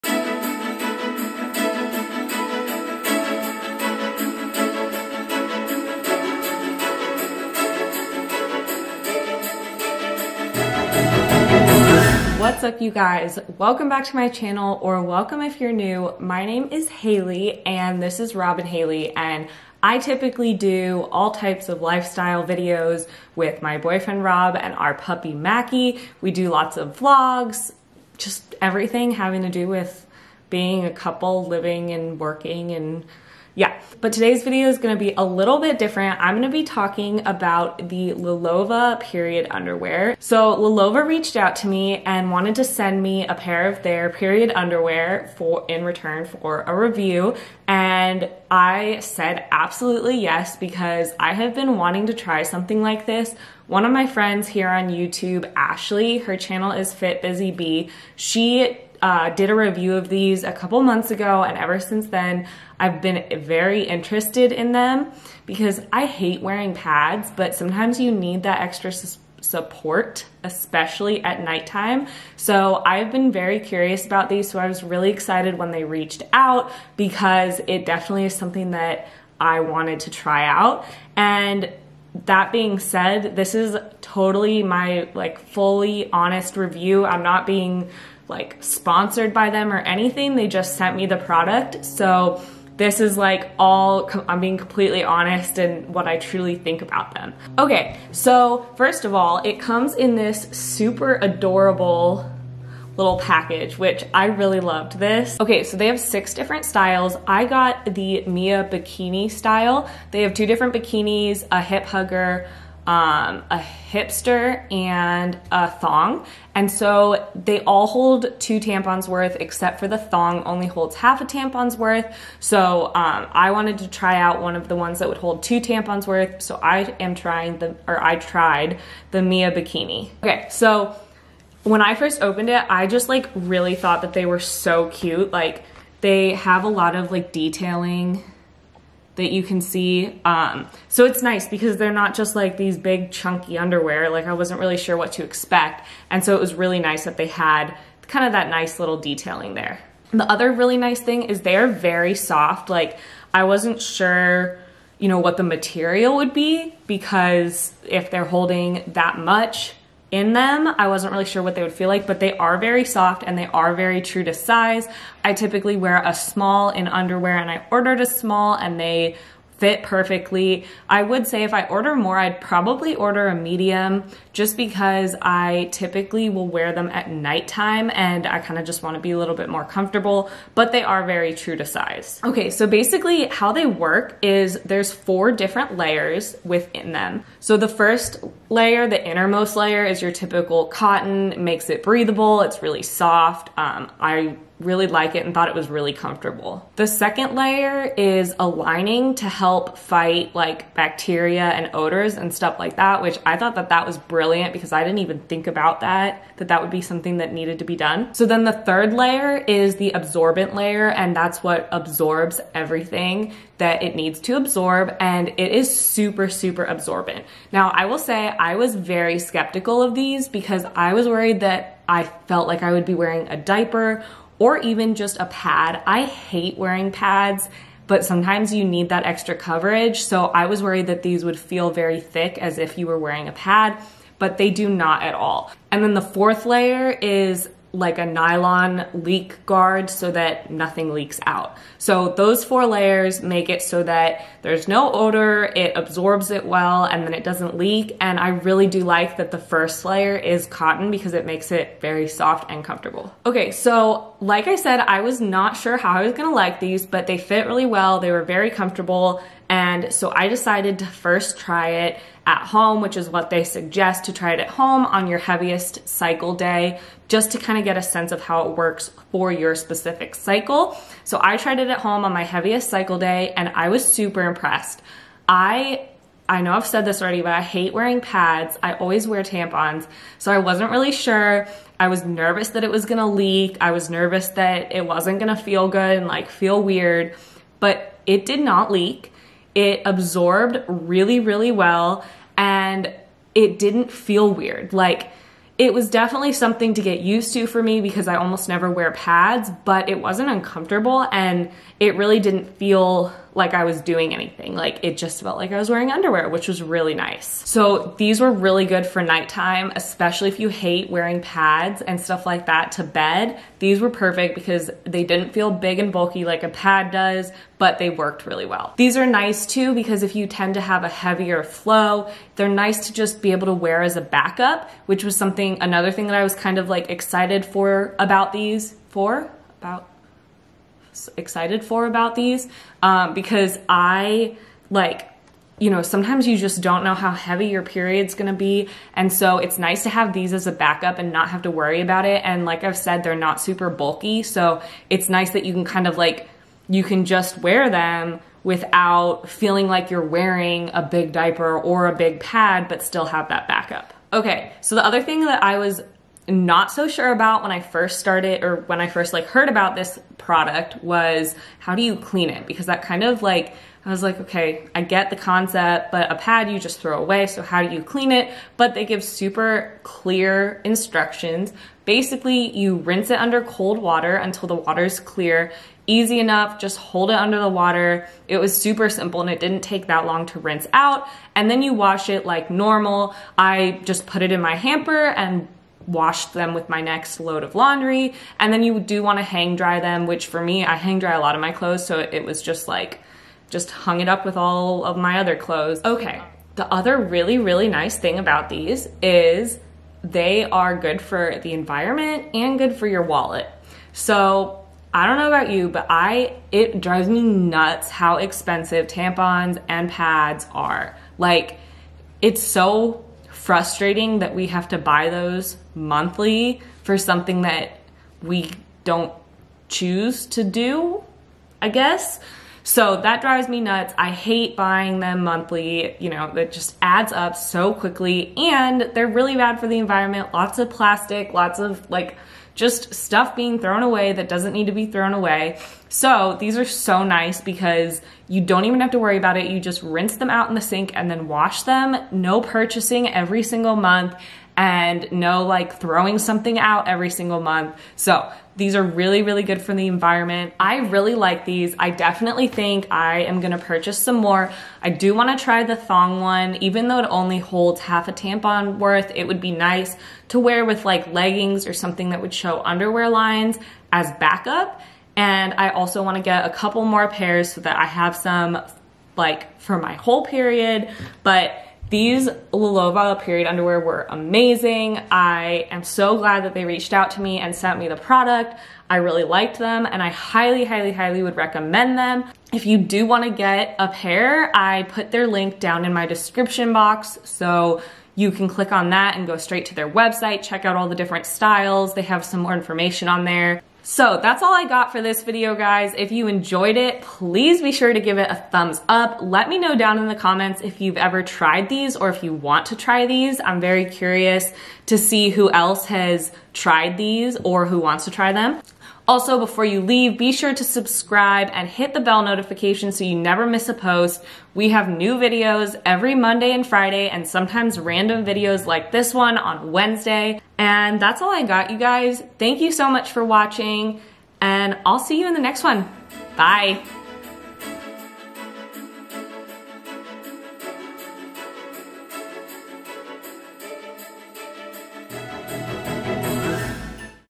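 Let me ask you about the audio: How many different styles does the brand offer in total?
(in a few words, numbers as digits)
6.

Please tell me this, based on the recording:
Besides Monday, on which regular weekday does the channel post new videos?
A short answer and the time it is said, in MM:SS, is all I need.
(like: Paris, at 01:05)
Friday, at 08:36.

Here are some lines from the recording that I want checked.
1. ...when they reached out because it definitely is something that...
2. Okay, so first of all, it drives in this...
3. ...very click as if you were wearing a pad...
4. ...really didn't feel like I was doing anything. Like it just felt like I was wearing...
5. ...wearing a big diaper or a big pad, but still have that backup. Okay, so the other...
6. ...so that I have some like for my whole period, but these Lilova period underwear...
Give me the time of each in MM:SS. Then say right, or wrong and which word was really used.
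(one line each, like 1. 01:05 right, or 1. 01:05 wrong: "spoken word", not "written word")
1. 01:15 right
2. 01:37 wrong: "comes", not "drives"
3. 03:51 wrong: "thick", not "click"
4. 05:01 right
5. 05:50 right
6. 07:47 right.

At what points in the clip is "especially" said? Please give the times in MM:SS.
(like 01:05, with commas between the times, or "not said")
01:10, 05:09.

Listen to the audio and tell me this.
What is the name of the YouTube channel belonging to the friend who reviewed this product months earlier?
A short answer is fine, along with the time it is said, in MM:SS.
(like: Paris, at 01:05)
Fit Busy Bee, at 00:56.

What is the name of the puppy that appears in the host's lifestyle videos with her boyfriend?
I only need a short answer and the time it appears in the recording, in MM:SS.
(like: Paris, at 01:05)
Mackey, at 00:25.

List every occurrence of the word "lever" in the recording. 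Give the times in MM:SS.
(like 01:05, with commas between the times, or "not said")
not said.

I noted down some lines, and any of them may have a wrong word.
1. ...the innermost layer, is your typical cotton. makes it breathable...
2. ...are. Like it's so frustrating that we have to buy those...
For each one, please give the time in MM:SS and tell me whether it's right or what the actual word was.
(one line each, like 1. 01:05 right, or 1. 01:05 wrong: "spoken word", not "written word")
1. 03:08 right
2. 06:50 right.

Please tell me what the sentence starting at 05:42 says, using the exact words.
And like I've said, they're not super bulky.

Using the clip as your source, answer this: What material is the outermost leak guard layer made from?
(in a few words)
Nylon.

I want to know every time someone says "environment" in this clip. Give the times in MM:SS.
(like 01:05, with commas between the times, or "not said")
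06:41, 07:09, 07:29.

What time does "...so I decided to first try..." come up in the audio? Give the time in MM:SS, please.
04:19.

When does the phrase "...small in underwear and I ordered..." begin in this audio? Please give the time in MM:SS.
02:46.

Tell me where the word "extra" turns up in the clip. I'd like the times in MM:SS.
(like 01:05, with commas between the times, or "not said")
01:08, 03:49.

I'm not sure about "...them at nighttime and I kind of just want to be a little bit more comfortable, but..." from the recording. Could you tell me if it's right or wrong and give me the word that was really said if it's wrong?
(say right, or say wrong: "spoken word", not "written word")
right.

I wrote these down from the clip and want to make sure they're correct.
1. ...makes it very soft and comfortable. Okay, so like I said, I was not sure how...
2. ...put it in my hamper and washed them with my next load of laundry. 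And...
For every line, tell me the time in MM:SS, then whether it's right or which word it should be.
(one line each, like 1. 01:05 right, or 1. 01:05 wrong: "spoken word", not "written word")
1. 04:11 right
2. 06:24 right.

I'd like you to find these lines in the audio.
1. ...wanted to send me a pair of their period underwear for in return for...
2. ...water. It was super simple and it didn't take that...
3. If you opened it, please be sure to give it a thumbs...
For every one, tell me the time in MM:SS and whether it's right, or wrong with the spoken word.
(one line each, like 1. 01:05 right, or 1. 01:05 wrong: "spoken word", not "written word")
1. 00:42 right
2. 06:17 right
3. 08:15 wrong: "enjoyed", not "opened".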